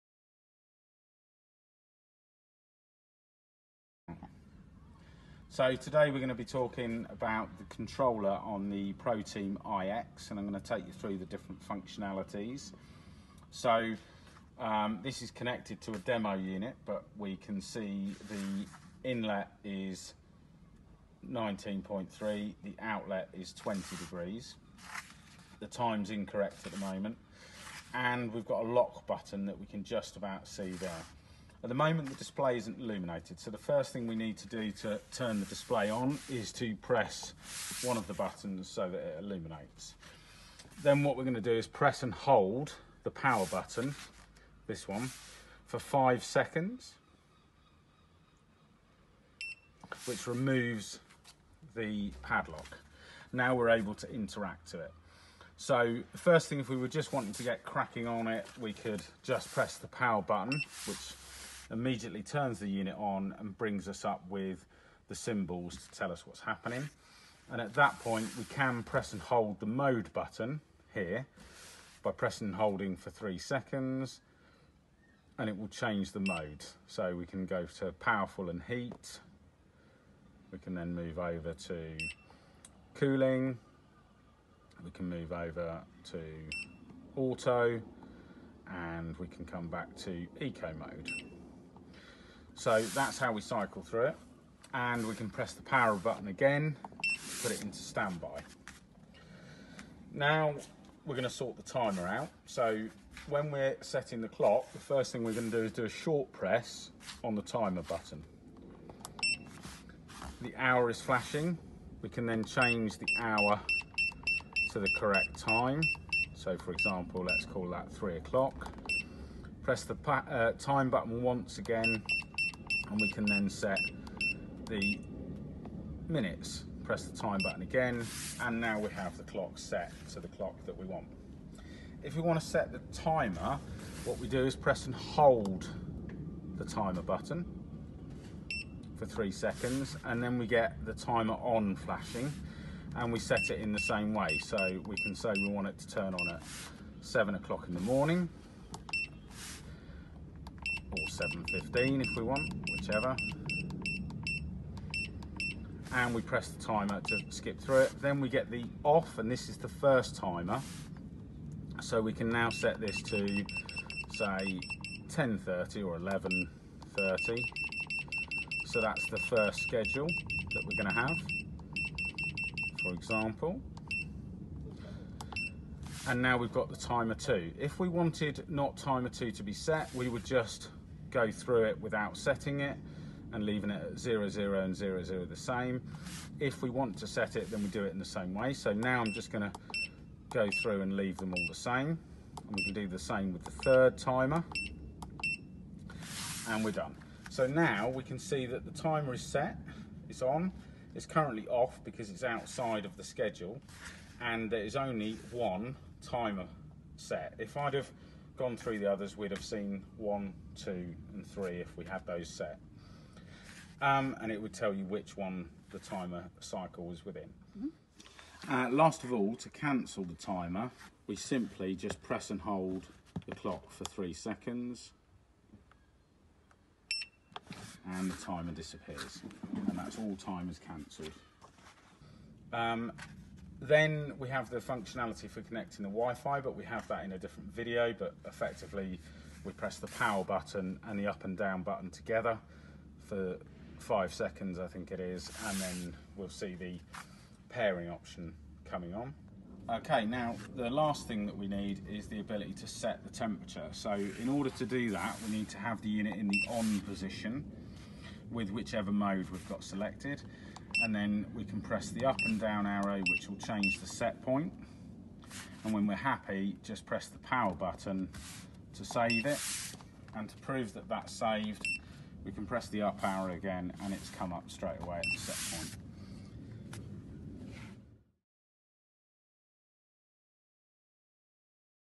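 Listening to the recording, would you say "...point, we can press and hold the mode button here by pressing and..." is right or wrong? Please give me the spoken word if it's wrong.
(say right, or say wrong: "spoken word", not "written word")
right.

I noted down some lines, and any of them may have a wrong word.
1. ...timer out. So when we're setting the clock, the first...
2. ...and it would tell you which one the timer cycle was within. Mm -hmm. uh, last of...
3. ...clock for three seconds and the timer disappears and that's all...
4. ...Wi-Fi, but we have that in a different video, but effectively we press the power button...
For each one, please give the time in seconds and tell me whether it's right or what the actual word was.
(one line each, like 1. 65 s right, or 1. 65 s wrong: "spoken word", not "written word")
1. 101 s right
2. 214 s right
3. 223 s right
4. 235 s right.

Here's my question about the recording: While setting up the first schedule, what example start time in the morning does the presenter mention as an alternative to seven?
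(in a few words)
7.15.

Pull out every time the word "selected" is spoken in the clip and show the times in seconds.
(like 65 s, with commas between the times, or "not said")
259 s.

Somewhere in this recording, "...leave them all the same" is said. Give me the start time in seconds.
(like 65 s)
190 s.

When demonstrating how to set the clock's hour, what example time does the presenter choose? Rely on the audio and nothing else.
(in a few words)
3 o'clock.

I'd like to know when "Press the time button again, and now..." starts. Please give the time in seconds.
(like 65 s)
126 s.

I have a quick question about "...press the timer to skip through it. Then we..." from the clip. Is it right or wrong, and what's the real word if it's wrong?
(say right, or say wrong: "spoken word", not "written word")
right.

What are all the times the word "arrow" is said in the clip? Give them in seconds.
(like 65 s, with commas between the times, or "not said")
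262 s, 273 s.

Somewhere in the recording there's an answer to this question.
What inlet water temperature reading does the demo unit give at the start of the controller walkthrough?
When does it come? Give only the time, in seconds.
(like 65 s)
21 s.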